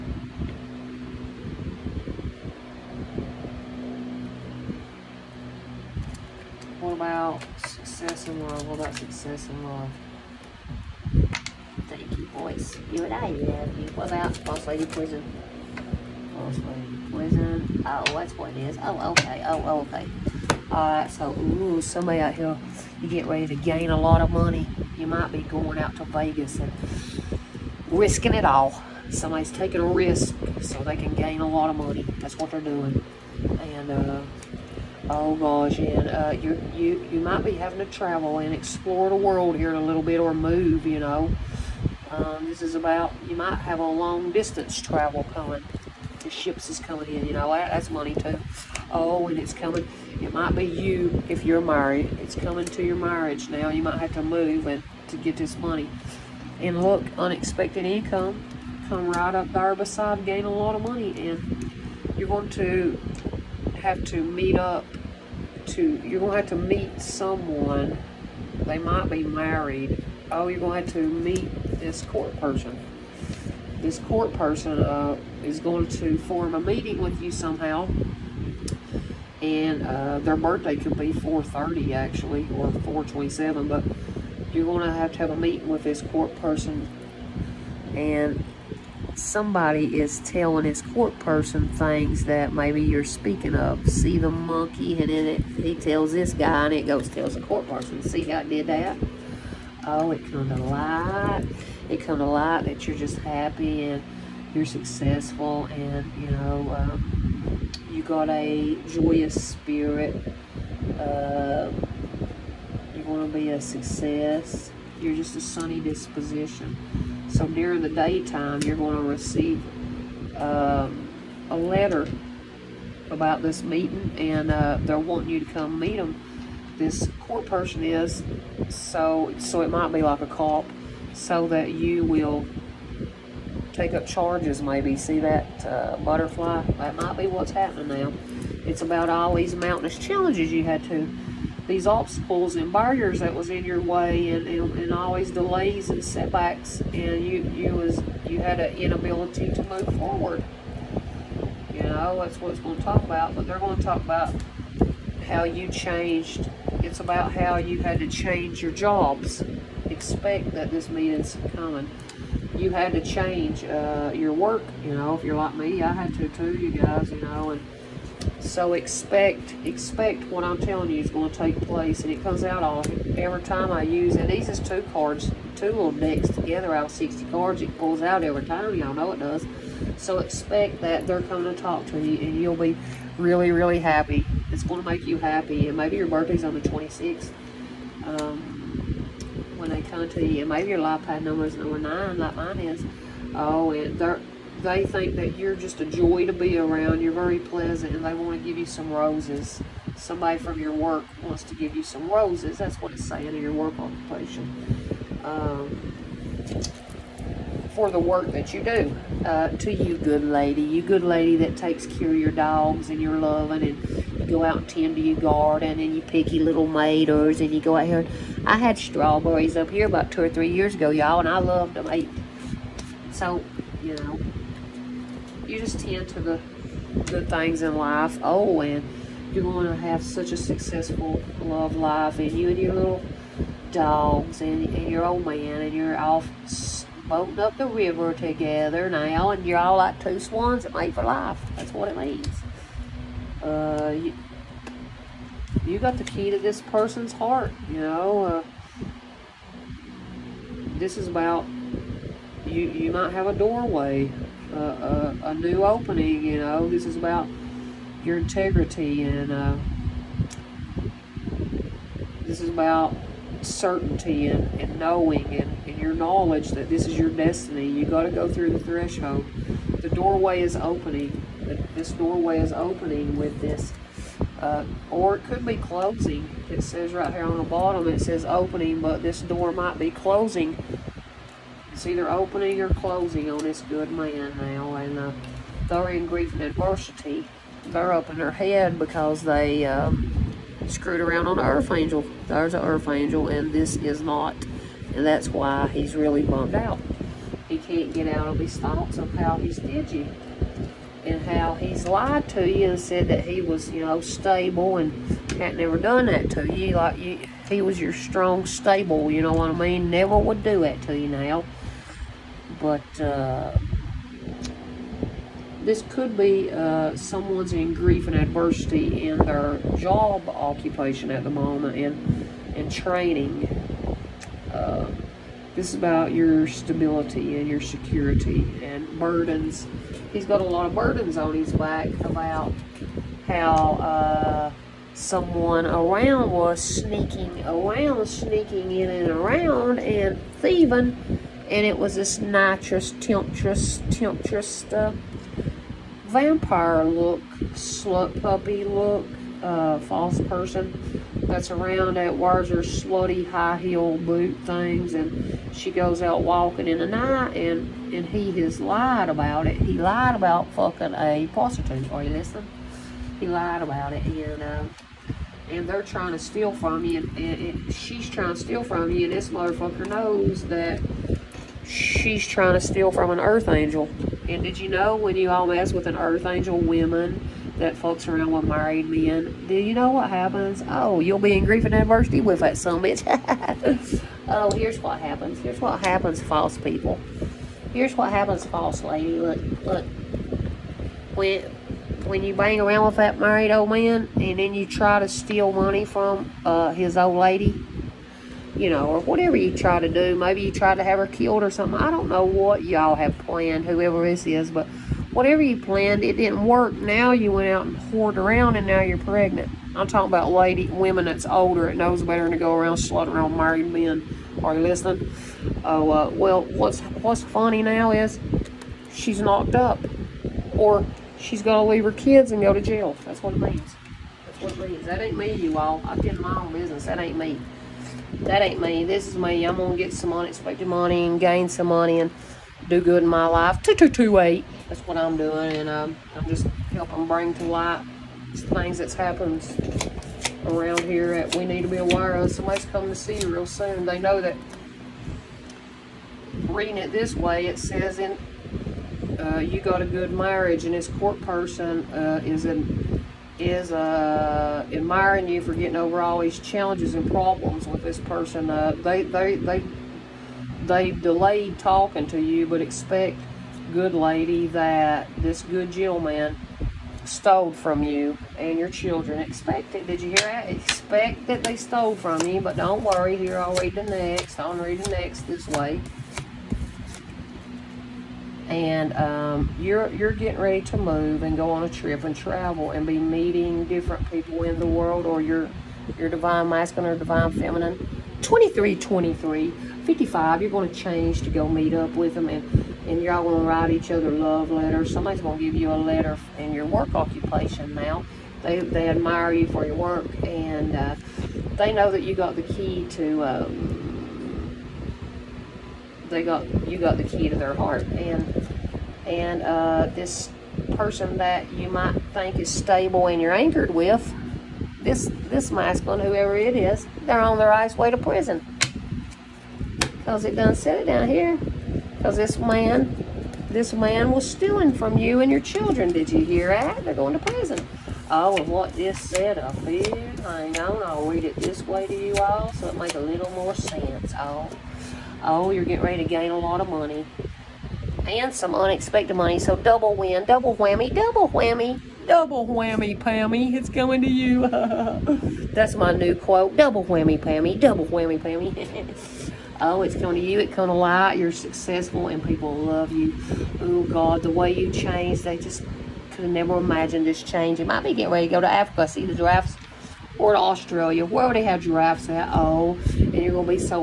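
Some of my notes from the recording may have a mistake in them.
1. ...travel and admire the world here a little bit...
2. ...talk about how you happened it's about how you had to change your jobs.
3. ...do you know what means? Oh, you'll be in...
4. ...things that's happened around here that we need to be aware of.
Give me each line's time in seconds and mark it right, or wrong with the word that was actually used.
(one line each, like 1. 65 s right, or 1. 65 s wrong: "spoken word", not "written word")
1. 37 s wrong: "explore", not "admire"
2. 153 s wrong: "changed", not "happened"
3. 379 s wrong: "happens", not "means"
4. 438 s right.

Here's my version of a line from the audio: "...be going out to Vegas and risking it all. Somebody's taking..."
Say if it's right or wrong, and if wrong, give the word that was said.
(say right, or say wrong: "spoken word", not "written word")
right.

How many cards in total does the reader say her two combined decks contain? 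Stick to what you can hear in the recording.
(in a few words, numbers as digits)
60.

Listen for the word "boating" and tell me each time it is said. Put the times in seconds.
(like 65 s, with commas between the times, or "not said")
237 s.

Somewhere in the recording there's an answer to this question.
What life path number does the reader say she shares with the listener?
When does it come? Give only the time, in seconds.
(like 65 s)
191 s.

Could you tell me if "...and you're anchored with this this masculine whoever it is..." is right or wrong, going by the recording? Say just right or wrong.
right.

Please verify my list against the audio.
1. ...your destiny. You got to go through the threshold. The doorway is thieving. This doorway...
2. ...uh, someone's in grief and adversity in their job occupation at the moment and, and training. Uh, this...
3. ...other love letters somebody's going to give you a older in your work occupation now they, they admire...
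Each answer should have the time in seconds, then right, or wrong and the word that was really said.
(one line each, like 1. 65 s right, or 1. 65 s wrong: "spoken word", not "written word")
1. 266 s wrong: "opening", not "thieving"
2. 316 s right
3. 493 s wrong: "letter", not "older".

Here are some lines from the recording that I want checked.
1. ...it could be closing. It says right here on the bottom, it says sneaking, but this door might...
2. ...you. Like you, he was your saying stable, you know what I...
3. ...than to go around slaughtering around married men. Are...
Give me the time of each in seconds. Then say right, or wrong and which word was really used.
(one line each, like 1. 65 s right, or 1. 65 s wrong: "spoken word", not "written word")
1. 275 s wrong: "opening", not "sneaking"
2. 306 s wrong: "strong", not "saying"
3. 412 s right.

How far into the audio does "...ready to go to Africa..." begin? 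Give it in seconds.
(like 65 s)
558 s.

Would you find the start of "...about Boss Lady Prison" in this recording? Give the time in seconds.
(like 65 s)
14 s.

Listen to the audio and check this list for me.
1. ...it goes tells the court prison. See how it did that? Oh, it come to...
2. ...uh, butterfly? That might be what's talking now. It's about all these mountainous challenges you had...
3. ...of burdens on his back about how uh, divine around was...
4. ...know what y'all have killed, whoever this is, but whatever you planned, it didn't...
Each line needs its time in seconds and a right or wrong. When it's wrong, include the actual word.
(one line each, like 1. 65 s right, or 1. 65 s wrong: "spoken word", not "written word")
1. 96 s wrong: "person", not "prison"
2. 135 s wrong: "happening", not "talking"
3. 330 s wrong: "someone", not "divine"
4. 402 s wrong: "planned", not "killed".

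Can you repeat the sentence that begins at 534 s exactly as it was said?
Oh oh, you're getting ready to gain a lot of money and some unexpected money.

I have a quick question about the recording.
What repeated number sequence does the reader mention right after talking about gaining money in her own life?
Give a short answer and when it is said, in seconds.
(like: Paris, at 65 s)
2228, at 433 s.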